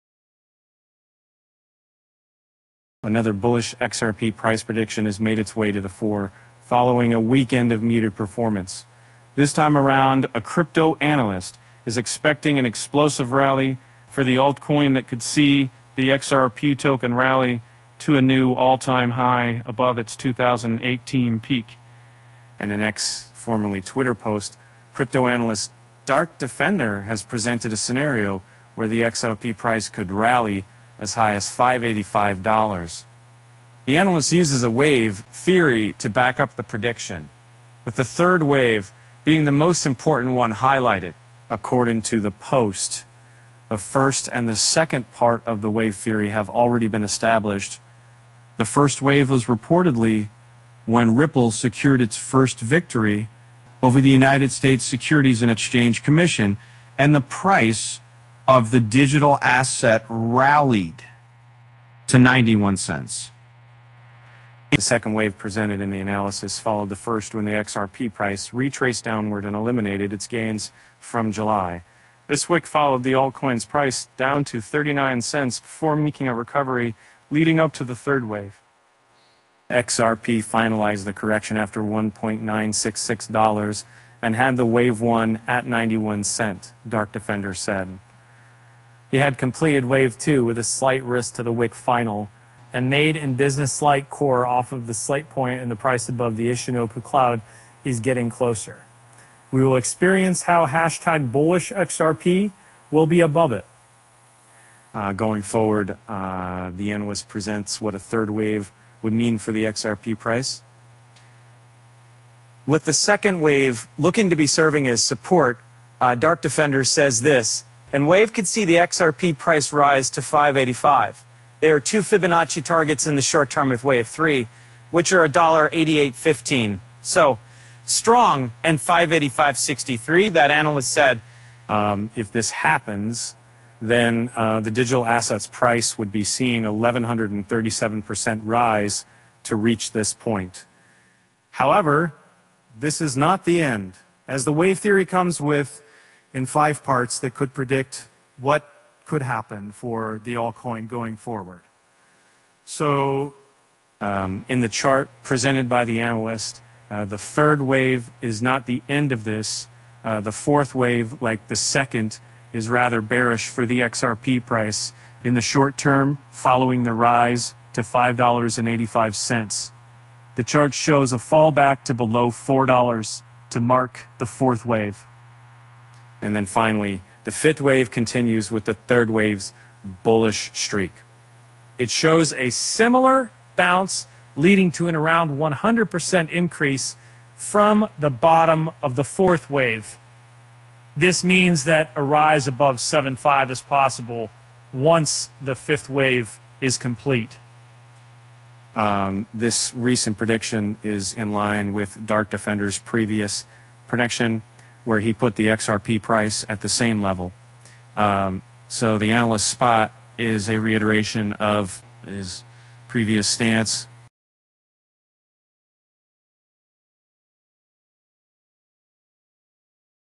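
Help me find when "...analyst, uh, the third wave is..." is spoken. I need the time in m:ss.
2:35.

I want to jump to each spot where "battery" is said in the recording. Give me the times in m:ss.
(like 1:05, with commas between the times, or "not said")
not said.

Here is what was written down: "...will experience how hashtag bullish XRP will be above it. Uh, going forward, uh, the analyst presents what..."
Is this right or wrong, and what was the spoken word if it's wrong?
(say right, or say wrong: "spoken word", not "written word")
right.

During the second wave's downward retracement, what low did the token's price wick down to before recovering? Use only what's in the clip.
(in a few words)
39 cents.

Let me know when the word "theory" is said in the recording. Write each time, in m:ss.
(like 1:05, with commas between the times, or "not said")
0:35, 0:45, 2:24.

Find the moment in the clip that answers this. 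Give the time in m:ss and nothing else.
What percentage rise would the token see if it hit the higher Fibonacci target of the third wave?
2:16.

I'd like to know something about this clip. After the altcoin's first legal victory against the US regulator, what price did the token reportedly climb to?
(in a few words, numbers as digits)
91 cents.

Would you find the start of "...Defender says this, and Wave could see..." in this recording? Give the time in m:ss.
1:56.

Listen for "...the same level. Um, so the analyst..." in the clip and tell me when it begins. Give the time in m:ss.
3:26.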